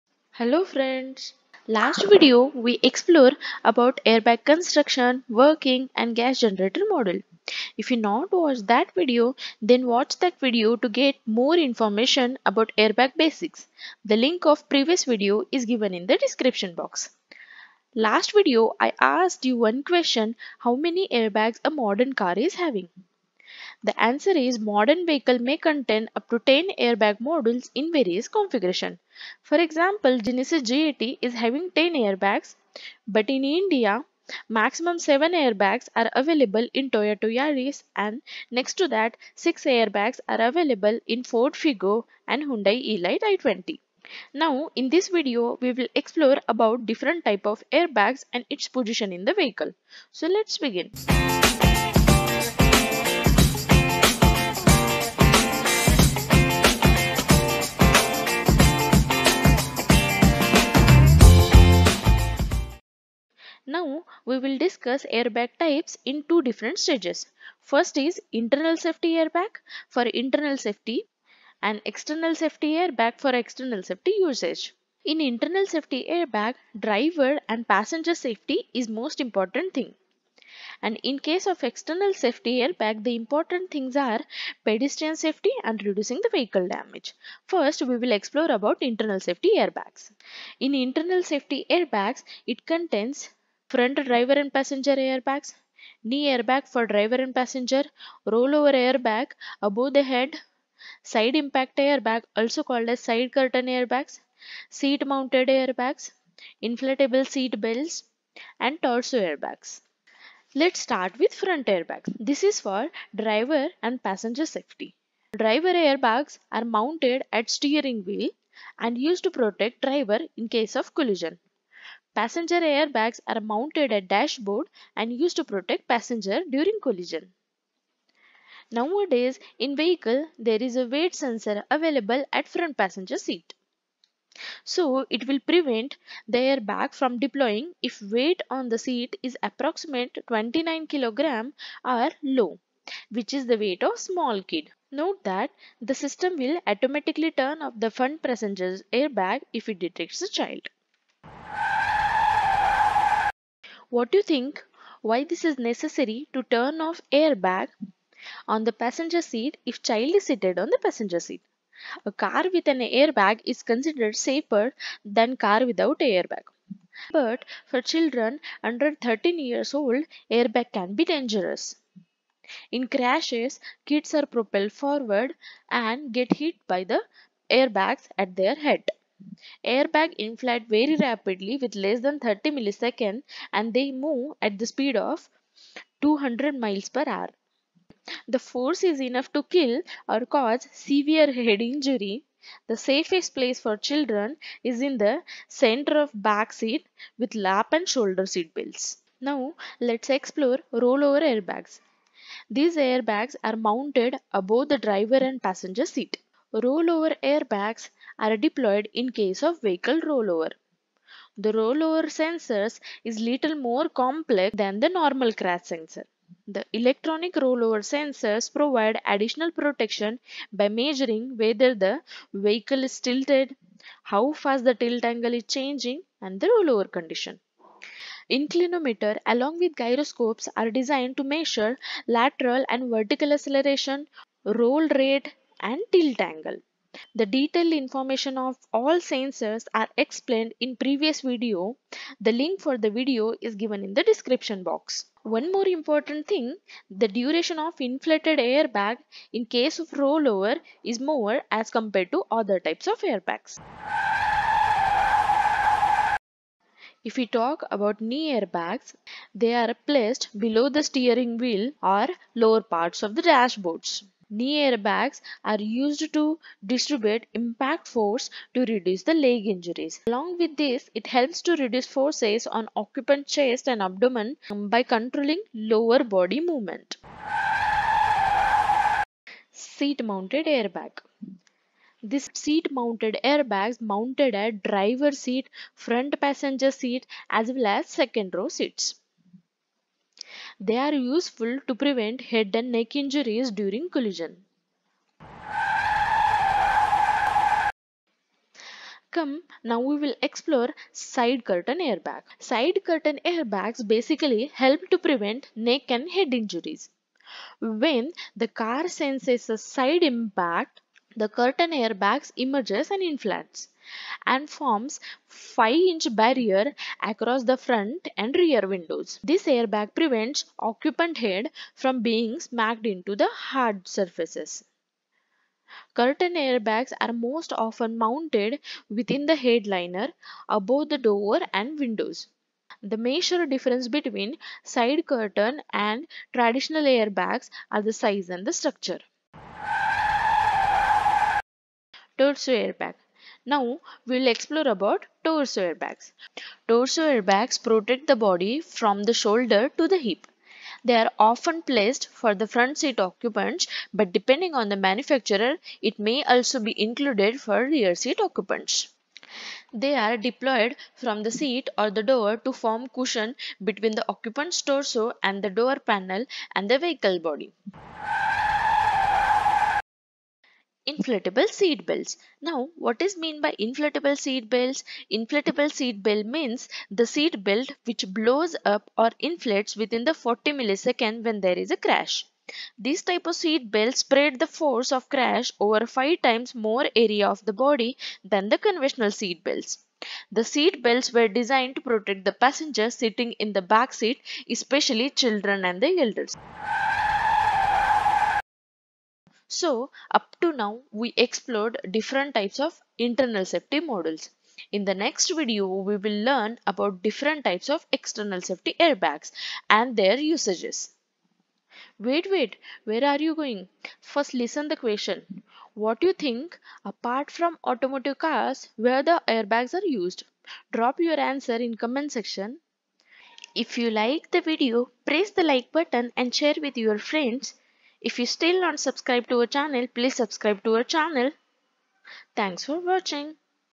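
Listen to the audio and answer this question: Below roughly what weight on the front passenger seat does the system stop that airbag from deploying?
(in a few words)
29 kg.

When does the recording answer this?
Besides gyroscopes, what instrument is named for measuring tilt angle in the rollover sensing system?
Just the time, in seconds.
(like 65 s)
228 s.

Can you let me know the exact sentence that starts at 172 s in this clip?
In crashes, kids are propelled forward and get hit by the airbags at their head.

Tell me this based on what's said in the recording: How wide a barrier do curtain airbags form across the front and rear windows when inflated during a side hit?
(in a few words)
5 inches.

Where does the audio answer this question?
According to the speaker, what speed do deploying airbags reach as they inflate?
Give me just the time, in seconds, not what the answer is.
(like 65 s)
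186 s.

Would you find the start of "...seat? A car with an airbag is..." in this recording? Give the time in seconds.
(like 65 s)
161 s.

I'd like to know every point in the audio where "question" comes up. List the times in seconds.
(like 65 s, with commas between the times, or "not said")
19 s, 414 s.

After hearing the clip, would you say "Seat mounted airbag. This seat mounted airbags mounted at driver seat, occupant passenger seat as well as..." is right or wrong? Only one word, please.
wrong.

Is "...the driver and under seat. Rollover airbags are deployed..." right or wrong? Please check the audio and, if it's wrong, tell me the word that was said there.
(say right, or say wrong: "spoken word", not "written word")
wrong: "passenger", not "under".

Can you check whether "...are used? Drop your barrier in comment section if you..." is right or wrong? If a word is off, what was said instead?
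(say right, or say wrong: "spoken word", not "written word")
wrong: "answer", not "barrier".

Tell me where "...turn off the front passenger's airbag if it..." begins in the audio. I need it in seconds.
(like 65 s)
147 s.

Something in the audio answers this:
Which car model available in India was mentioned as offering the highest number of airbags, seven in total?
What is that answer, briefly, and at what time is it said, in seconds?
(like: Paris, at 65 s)
Toyota Yaris, at 36 s.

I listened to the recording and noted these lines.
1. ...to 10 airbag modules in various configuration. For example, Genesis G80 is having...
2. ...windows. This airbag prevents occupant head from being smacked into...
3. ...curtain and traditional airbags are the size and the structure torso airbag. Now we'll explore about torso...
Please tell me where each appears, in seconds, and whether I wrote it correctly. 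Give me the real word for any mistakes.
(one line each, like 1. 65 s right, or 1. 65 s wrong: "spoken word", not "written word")
1. 26 s right
2. 318 s right
3. 335 s right.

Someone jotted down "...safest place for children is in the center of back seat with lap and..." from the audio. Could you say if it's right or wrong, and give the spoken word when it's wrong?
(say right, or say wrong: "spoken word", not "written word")
right.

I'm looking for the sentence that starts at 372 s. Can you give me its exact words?
Now, what is mean by inflatable seat belts?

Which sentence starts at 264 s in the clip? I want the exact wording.
Knee airbags are used to distribute impact force to reduce the leg injuries.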